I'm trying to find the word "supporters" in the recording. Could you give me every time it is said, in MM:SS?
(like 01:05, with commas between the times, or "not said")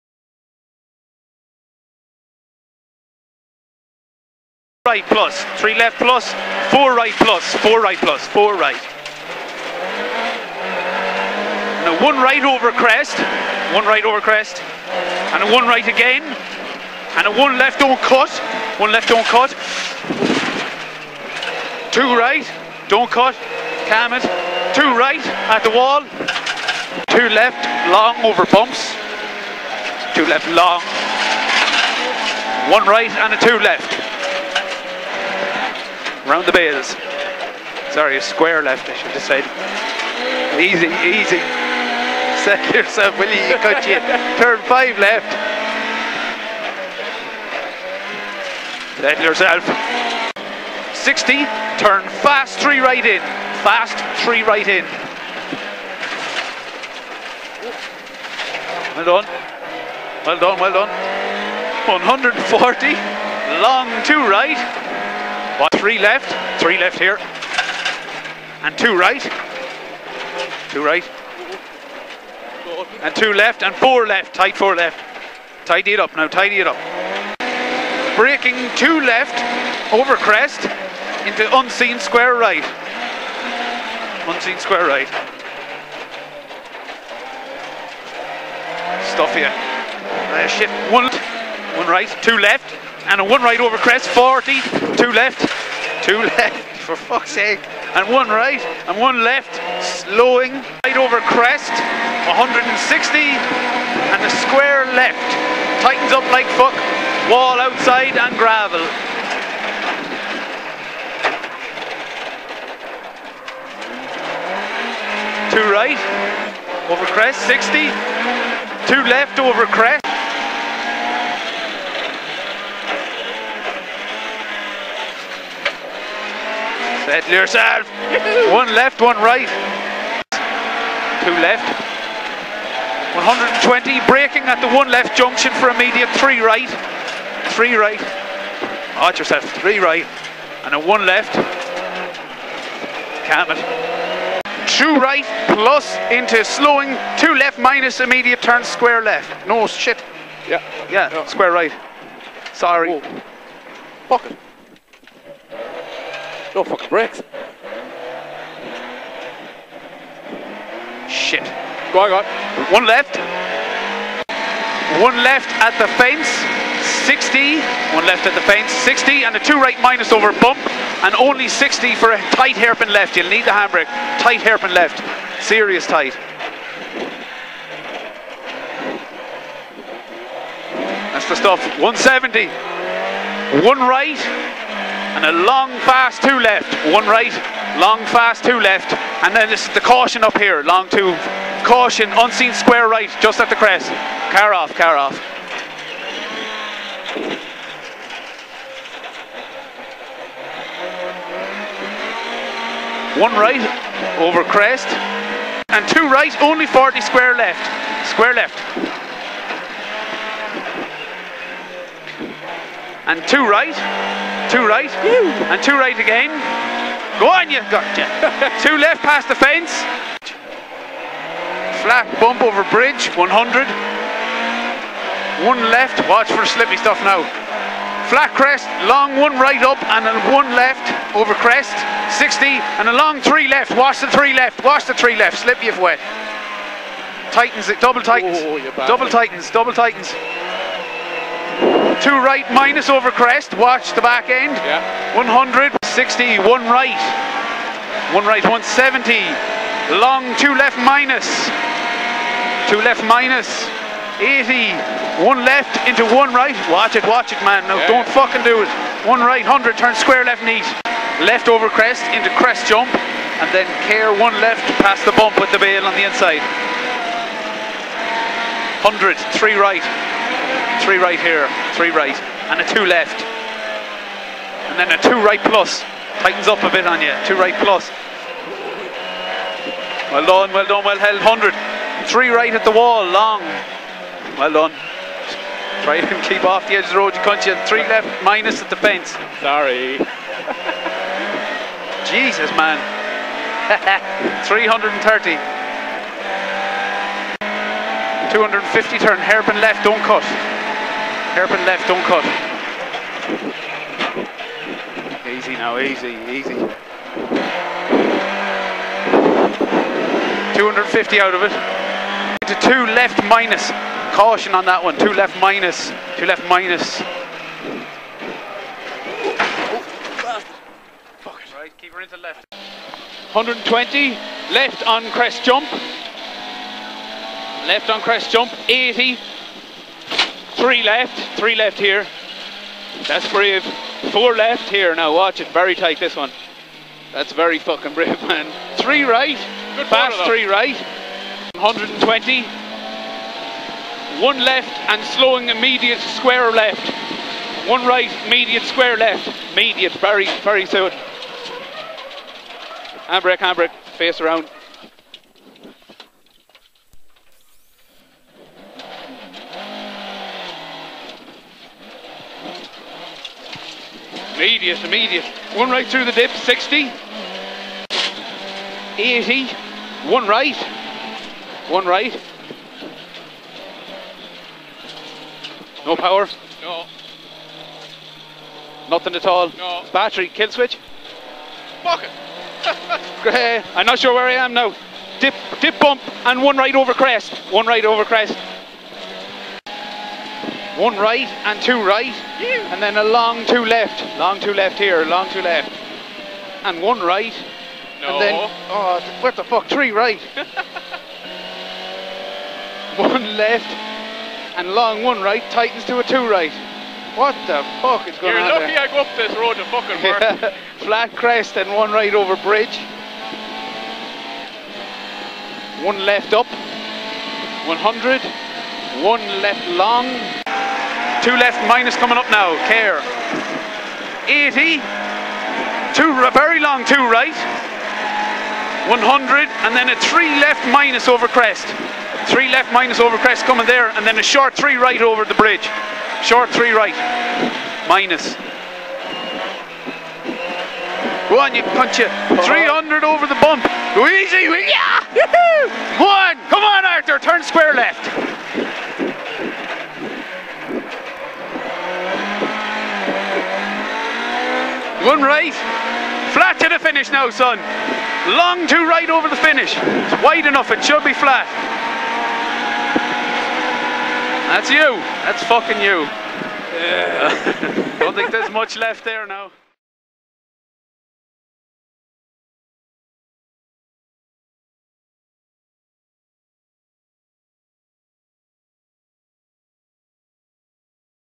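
not said.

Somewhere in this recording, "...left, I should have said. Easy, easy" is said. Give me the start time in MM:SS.
00:38.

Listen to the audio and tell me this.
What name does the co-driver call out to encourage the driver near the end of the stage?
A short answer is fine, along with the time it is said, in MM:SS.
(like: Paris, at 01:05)
Arthur, at 07:26.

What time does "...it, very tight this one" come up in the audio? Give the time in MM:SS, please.
05:35.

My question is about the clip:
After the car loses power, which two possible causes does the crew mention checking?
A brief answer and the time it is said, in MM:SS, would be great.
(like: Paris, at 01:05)
Battery, kill switch, at 06:19.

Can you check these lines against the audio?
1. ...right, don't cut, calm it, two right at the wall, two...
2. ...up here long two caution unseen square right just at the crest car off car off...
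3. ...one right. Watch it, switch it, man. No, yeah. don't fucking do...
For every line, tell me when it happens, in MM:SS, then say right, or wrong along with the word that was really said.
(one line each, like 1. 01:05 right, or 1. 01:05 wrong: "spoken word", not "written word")
1. 00:22 right
2. 03:10 right
3. 04:16 wrong: "watch", not "switch".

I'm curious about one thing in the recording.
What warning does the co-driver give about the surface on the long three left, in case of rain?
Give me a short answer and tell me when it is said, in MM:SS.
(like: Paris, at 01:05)
Slip if wet, at 03:55.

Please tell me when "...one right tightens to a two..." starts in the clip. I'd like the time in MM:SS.
06:45.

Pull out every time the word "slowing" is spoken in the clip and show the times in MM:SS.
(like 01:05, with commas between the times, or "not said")
01:39, 02:26, 05:45.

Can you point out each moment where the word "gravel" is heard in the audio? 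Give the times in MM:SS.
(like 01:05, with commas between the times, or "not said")
01:48.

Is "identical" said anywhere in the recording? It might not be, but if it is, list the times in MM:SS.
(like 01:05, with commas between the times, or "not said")
not said.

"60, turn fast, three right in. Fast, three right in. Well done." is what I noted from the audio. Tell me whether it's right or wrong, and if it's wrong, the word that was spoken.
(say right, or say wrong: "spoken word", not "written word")
right.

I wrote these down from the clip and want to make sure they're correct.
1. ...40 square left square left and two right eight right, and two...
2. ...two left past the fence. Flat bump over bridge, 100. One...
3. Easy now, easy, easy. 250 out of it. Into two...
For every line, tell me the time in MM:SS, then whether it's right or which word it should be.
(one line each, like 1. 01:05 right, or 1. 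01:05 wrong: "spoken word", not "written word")
1. 03:26 wrong: "two", not "eight"
2. 03:38 right
3. 05:05 right.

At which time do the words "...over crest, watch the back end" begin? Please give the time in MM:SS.
04:02.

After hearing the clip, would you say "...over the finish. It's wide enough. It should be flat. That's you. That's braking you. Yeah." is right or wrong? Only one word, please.
wrong.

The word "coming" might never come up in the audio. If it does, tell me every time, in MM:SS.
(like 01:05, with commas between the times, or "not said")
07:01, 07:13.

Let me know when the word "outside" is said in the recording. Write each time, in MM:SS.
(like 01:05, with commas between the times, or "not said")
01:47.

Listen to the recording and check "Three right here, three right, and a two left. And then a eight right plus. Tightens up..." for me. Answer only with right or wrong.
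wrong.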